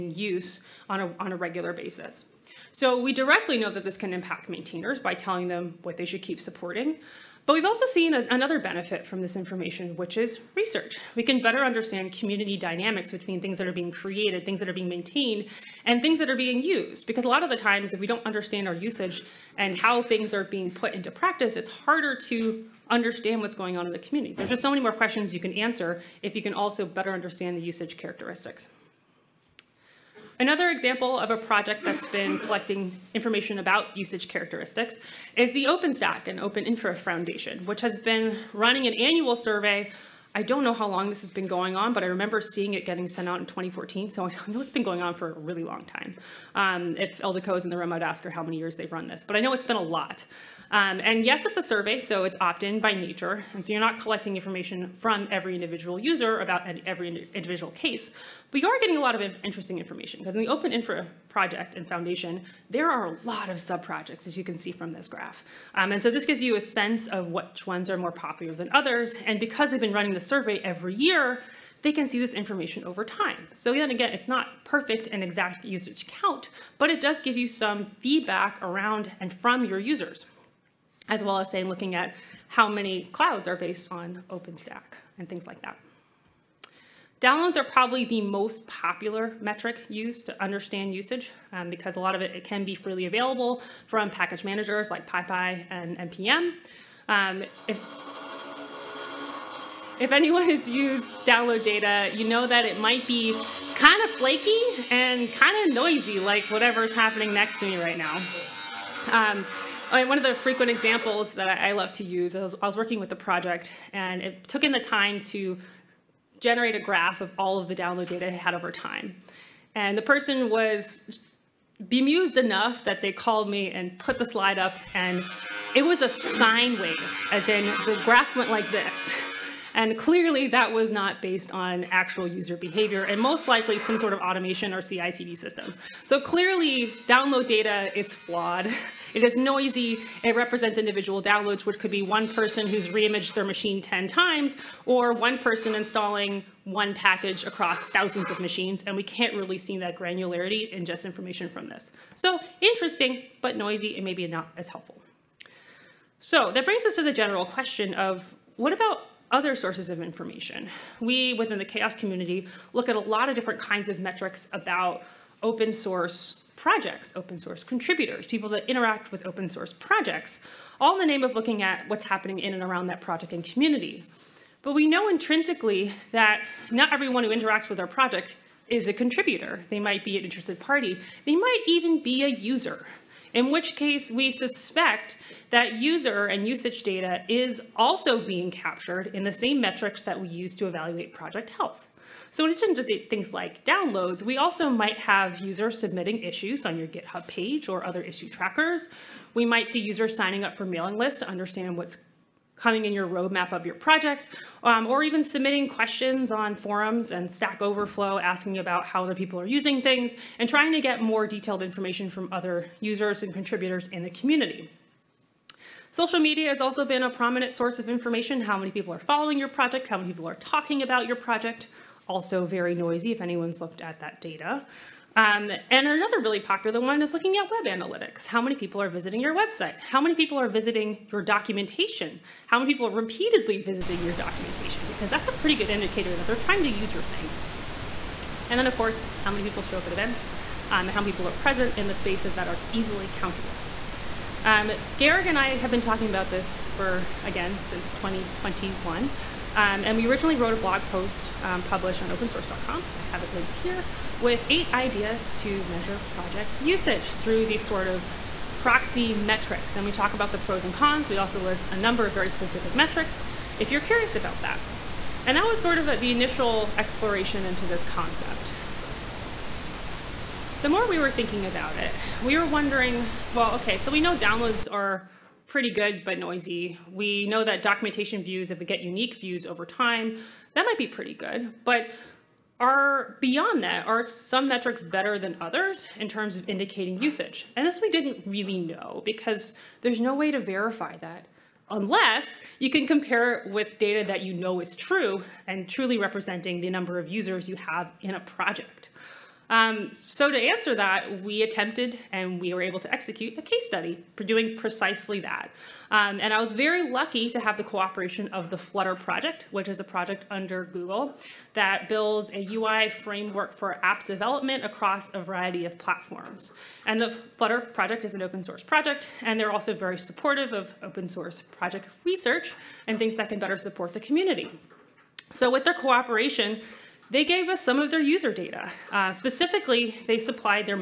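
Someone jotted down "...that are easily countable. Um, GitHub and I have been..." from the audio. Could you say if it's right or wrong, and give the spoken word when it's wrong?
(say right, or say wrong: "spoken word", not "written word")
wrong: "Georg", not "GitHub".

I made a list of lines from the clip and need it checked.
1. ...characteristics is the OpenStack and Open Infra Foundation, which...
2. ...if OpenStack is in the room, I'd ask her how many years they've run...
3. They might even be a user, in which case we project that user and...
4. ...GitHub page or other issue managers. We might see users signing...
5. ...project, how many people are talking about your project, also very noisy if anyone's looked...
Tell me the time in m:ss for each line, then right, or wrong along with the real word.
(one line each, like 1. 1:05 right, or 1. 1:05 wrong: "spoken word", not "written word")
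1. 0:34 right
2. 0:46 wrong: "Eldeco", not "OpenStack"
3. 3:01 wrong: "suspect", not "project"
4. 3:16 wrong: "trackers", not "managers"
5. 3:39 right.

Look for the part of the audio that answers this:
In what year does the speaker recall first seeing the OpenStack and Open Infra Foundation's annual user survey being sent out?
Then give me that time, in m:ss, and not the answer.
0:43.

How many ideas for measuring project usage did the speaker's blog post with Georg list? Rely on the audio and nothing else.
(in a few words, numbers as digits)
8.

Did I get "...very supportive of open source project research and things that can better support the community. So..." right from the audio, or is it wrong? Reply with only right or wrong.
right.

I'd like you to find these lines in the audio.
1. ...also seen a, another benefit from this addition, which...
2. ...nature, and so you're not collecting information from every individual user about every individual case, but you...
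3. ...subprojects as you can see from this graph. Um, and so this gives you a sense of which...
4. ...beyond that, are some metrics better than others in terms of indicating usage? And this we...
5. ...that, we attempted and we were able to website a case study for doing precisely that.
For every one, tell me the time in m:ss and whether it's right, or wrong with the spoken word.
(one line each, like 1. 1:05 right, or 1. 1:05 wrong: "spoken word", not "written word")
1. 0:07 wrong: "information", not "addition"
2. 0:52 right
3. 1:03 right
4. 4:43 right
5. 5:00 wrong: "execute", not "website".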